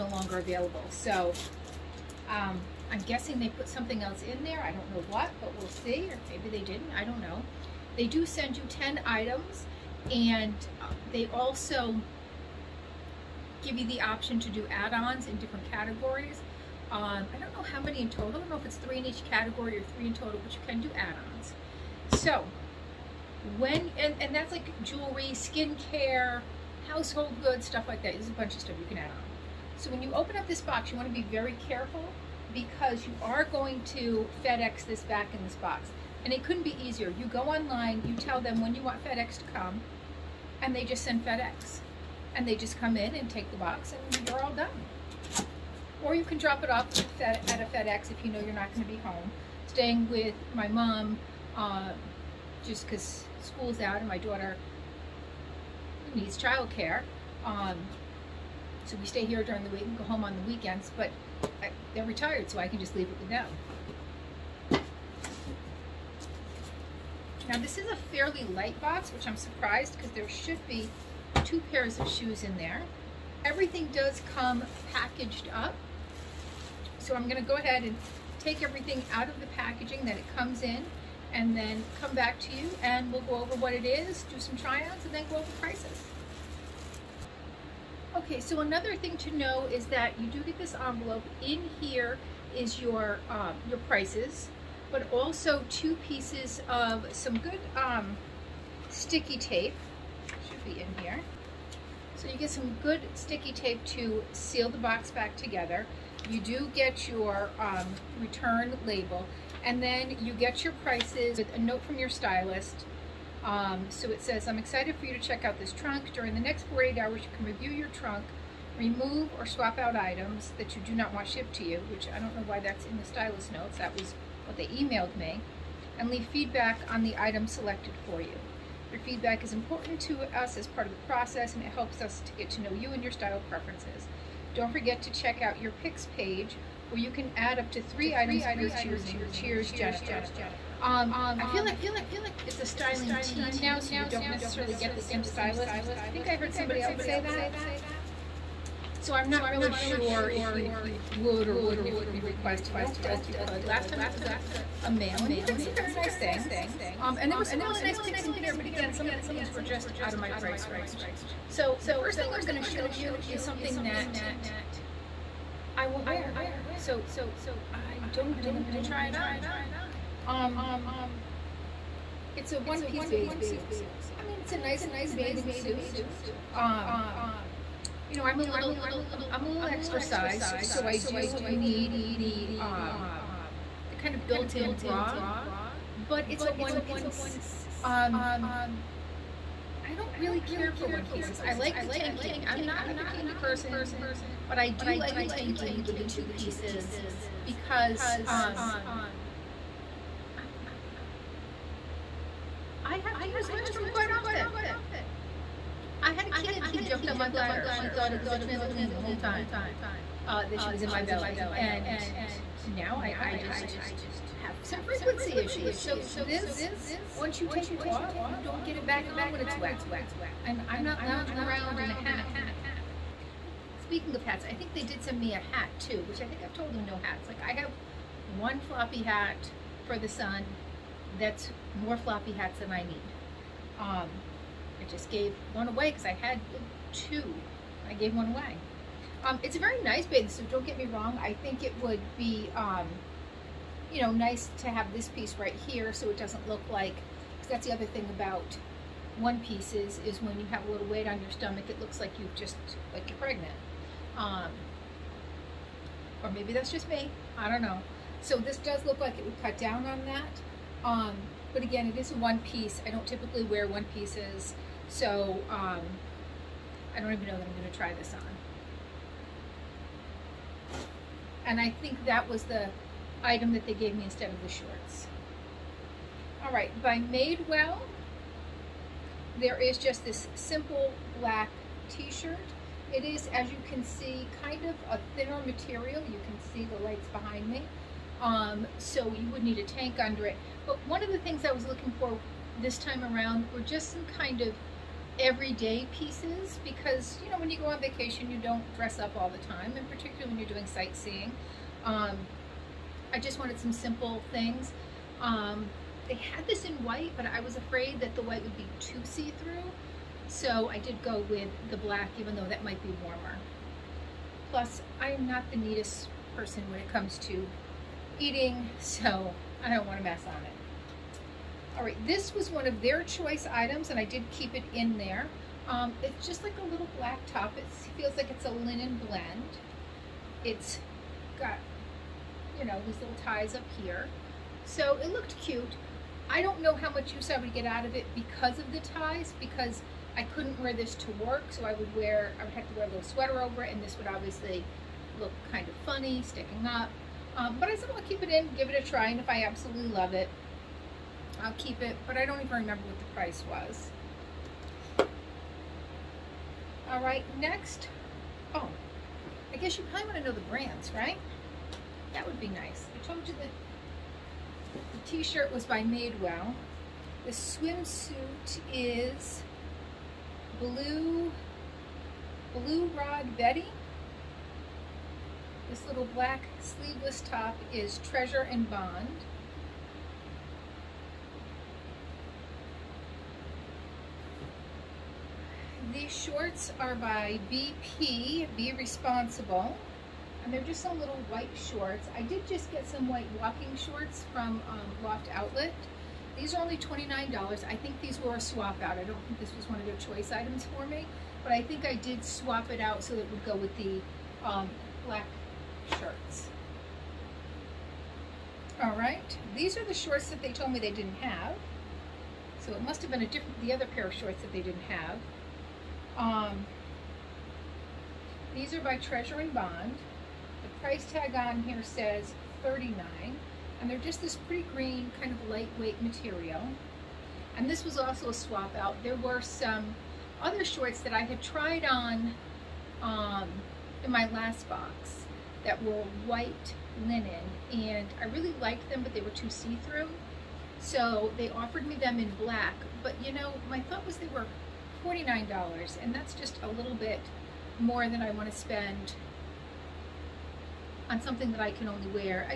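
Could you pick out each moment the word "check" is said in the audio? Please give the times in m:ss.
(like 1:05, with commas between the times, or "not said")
1:55, 2:15.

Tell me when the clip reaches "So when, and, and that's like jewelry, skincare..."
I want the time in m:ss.
0:22.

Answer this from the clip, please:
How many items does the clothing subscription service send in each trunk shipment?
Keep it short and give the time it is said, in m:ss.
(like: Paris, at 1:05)
10, at 0:08.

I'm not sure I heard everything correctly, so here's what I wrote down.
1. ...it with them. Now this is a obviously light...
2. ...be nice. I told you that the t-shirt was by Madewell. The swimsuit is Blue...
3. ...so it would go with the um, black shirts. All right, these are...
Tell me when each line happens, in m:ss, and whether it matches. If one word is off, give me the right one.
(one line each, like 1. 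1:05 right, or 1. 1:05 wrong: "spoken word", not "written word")
1. 1:03 wrong: "fairly", not "obviously"
2. 6:02 right
3. 6:43 right.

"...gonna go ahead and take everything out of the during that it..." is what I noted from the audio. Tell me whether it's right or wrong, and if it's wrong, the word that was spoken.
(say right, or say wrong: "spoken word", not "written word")
wrong: "packaging", not "during".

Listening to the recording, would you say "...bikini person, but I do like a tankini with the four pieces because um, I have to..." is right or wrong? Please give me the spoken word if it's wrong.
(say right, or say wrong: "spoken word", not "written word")
wrong: "two", not "four".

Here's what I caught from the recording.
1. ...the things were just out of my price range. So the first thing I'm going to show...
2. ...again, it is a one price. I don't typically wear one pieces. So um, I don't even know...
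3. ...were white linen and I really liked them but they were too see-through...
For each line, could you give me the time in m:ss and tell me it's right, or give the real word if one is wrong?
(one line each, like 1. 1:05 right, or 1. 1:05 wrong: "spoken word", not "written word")
1. 2:39 right
2. 4:21 wrong: "piece", not "price"
3. 7:15 right.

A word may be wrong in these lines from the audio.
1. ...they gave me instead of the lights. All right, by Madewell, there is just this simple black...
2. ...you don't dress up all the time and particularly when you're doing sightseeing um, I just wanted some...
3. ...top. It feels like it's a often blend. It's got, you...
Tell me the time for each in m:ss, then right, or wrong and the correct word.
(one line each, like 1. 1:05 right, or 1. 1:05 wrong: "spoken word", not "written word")
1. 4:33 wrong: "shorts", not "lights"
2. 4:58 right
3. 5:27 wrong: "linen", not "often".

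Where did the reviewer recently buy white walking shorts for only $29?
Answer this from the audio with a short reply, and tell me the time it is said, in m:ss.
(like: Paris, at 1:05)
Loft Outlet, at 6:35.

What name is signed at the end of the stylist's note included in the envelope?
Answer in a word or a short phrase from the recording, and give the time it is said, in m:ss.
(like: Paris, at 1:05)
Jennifer, at 2:19.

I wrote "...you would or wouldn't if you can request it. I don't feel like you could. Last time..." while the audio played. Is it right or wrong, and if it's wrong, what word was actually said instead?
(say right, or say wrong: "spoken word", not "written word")
right.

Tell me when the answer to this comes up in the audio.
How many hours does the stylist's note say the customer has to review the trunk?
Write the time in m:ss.
1:56.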